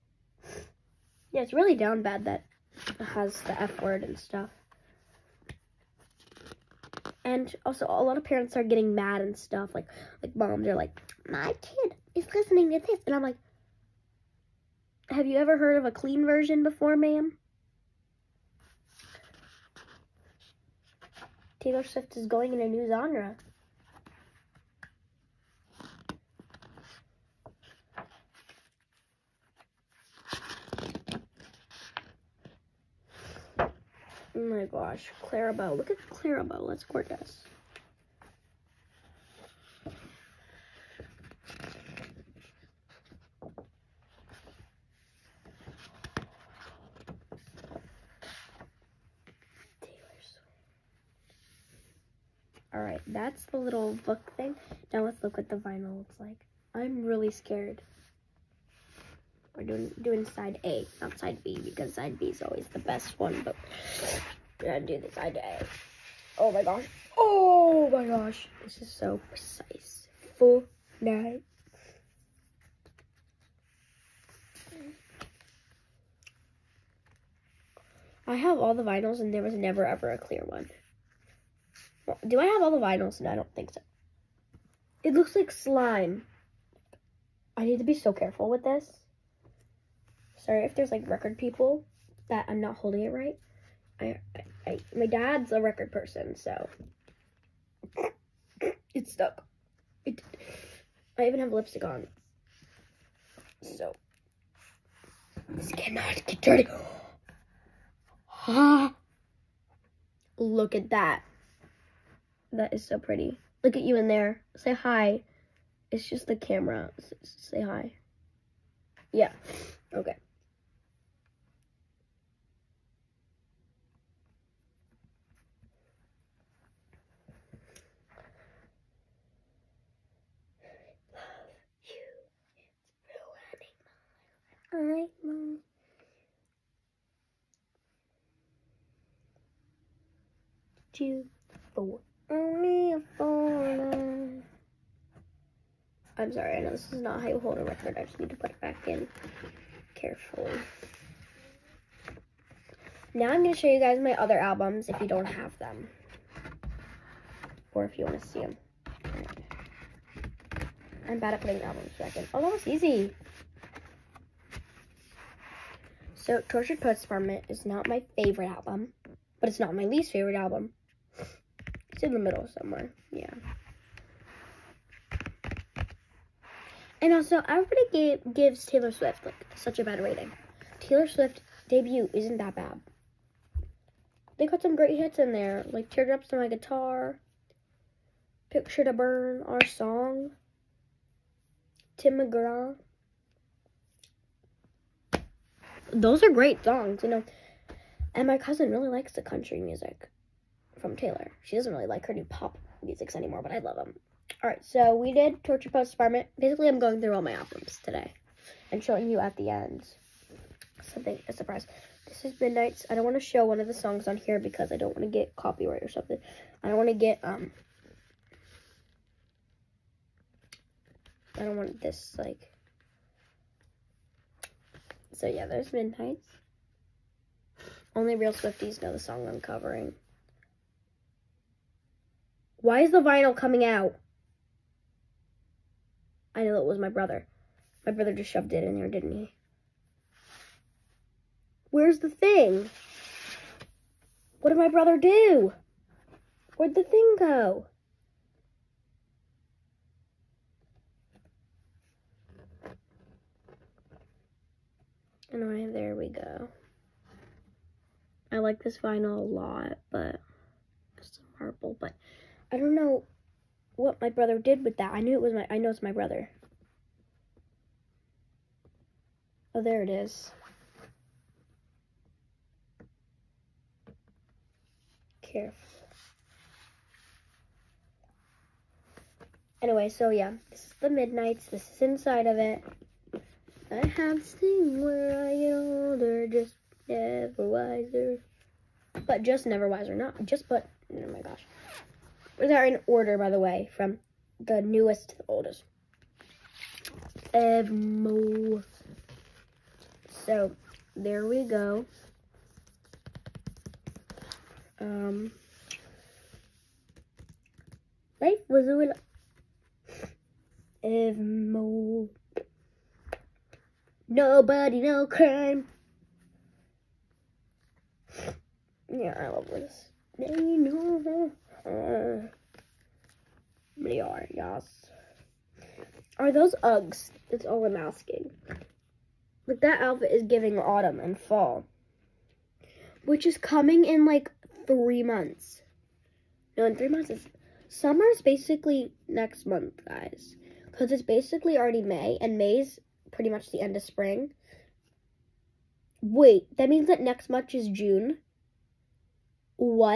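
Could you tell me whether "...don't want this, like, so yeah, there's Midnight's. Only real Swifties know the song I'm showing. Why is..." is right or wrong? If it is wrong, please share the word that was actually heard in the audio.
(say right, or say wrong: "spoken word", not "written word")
wrong: "covering", not "showing".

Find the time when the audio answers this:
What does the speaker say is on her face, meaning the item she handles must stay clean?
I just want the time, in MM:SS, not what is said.
01:41.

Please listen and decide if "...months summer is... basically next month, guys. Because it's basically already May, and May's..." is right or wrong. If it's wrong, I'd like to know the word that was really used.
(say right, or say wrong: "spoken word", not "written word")
right.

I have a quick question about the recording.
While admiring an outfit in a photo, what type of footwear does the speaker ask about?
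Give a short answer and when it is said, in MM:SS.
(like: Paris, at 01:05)
Uggs, at 05:26.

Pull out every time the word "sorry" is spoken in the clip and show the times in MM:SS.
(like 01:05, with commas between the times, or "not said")
01:30, 02:26.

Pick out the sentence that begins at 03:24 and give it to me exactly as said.
All right, so we did Torture Poets Department.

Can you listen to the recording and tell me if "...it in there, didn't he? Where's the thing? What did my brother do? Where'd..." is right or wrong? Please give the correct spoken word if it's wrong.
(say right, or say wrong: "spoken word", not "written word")
right.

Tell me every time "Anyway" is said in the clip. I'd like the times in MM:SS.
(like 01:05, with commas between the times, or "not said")
04:15, 04:39.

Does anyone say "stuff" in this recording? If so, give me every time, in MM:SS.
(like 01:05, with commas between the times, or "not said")
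00:04, 00:09.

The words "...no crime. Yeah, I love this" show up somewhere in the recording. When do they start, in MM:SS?
05:14.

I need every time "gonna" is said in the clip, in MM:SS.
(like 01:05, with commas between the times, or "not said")
01:04.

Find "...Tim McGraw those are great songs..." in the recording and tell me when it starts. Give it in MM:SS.
03:11.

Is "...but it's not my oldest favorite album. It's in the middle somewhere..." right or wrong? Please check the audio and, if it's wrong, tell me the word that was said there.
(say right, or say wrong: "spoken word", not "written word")
wrong: "least", not "oldest".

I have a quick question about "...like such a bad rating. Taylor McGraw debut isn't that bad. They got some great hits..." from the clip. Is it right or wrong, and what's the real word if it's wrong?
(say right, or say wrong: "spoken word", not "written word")
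wrong: "Swift", not "McGraw".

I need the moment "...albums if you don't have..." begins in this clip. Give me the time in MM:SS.
02:34.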